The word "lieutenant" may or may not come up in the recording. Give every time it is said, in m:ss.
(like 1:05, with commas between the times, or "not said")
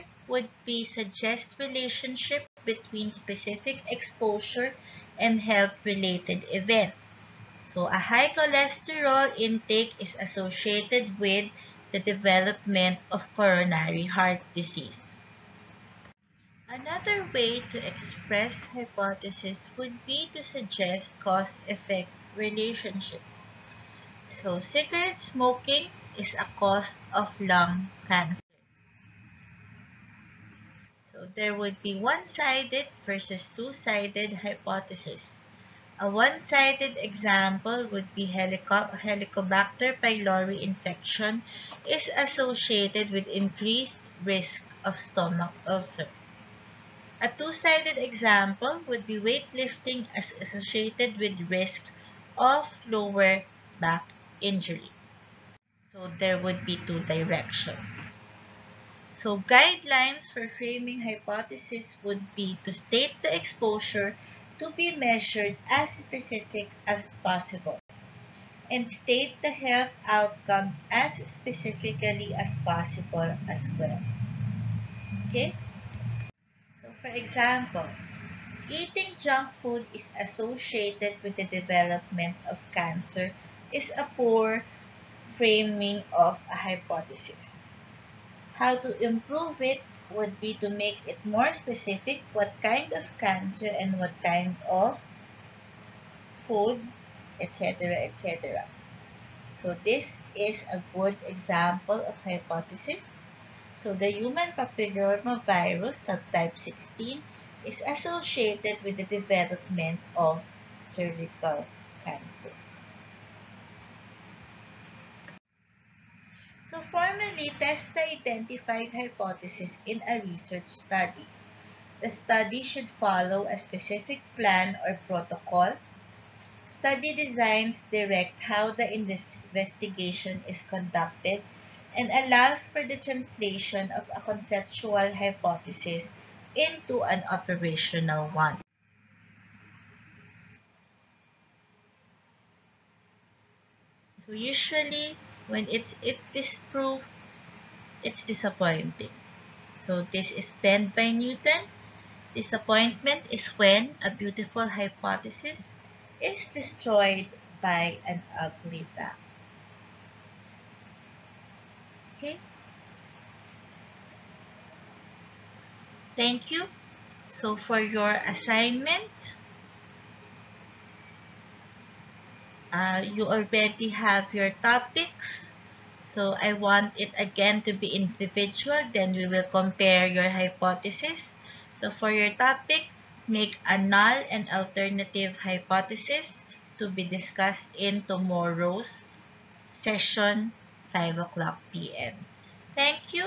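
not said.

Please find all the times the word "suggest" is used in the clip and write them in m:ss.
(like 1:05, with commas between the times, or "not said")
0:00, 0:20.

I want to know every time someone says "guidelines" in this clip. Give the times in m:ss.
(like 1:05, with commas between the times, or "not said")
0:59.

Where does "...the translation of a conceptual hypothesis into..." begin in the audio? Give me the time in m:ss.
2:12.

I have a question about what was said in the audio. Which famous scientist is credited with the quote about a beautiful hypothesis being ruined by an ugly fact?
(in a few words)
Newton.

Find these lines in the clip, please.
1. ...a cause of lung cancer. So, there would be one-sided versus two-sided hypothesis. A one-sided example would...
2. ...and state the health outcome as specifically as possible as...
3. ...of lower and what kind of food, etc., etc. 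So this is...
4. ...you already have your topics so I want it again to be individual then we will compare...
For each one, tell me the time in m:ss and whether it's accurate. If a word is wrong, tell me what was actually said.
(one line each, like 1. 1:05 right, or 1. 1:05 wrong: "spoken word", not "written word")
1. 0:26 right
2. 1:08 right
3. 1:32 wrong: "cancer", not "lower"
4. 2:53 right.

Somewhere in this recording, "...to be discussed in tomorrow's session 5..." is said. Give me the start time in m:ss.
3:06.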